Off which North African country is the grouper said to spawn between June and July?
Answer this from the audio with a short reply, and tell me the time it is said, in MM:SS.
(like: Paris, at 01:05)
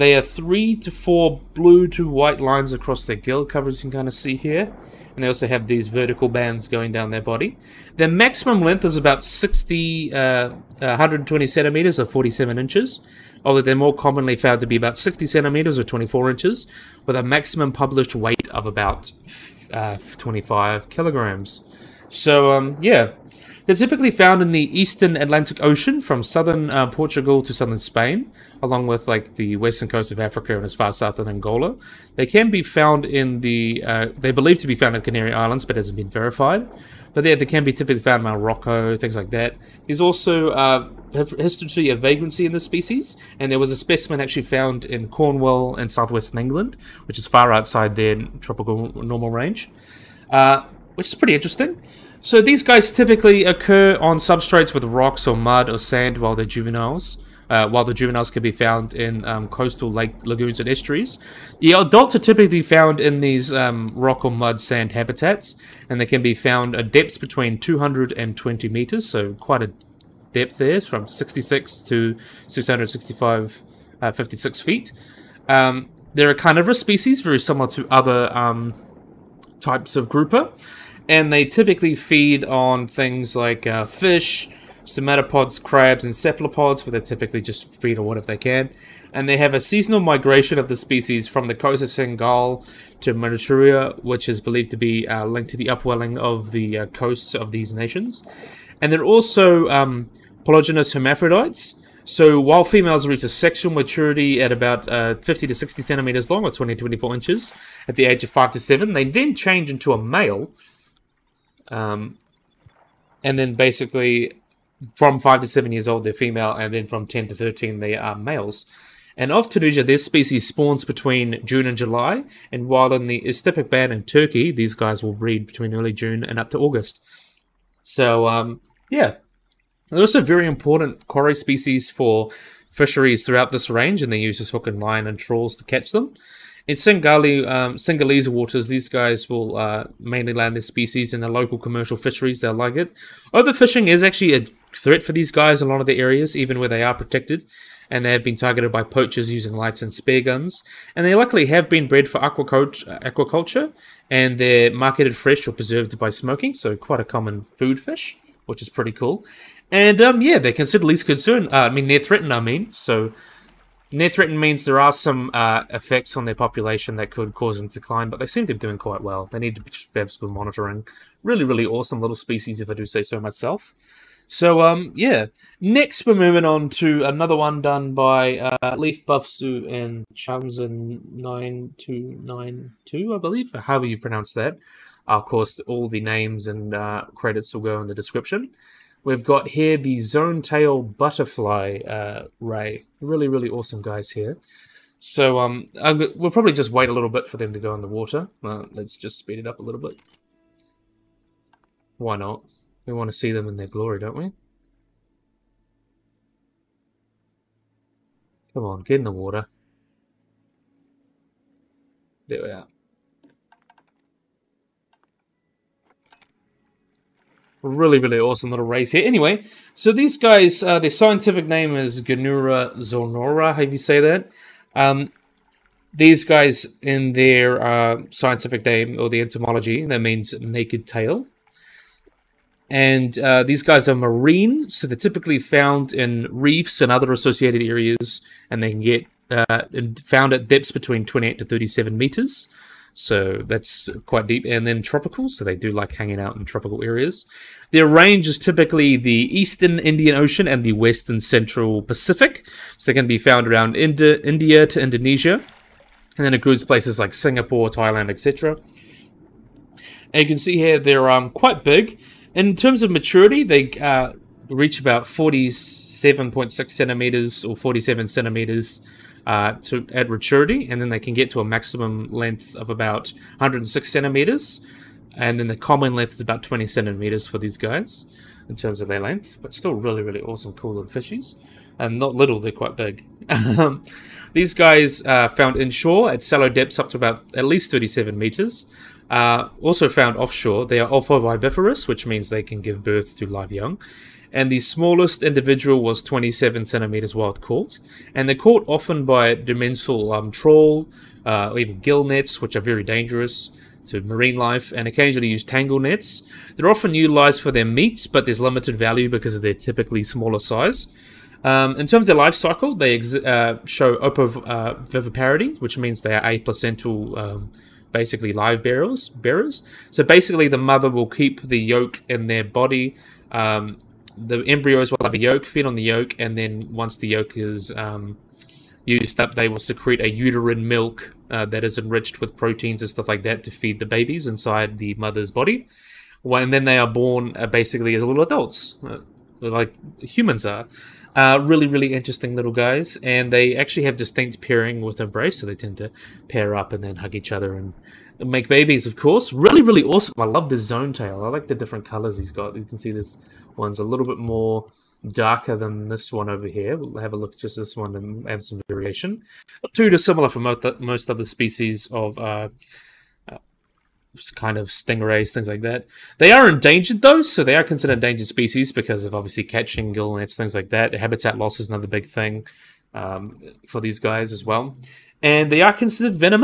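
Tunisia, at 01:59.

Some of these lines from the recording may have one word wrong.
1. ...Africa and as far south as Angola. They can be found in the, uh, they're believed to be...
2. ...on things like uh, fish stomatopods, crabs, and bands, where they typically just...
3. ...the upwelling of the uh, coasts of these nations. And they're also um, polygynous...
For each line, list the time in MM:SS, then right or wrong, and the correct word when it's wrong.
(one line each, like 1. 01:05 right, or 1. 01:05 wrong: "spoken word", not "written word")
1. 00:30 right
2. 01:22 wrong: "cephalopods", not "bands"
3. 01:35 right.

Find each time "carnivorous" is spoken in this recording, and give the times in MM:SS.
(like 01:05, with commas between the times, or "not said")
01:16.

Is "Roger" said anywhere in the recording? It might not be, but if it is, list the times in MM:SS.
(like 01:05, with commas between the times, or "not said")
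not said.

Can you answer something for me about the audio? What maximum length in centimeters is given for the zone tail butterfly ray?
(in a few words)
106 centimeters.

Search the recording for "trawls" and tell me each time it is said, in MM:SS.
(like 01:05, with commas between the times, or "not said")
02:15, 05:00.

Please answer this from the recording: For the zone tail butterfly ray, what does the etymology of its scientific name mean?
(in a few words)
naked tail.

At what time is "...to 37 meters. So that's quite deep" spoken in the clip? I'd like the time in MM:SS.
04:01.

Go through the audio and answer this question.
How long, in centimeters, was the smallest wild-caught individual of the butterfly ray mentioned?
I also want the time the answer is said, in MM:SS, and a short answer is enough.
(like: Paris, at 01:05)
27 centimeters, at 04:56.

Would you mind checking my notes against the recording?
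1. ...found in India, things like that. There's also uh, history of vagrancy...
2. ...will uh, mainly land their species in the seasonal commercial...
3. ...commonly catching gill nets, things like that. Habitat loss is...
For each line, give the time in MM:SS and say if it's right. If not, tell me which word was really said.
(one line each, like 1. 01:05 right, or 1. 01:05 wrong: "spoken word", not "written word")
1. 00:38 wrong: "Morocco", not "India"
2. 02:19 wrong: "local", not "seasonal"
3. 06:09 wrong: "obviously", not "commonly".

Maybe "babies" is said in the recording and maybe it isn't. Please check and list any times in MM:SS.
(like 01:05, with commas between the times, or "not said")
05:33, 05:48.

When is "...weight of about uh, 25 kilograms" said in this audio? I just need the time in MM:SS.
00:18.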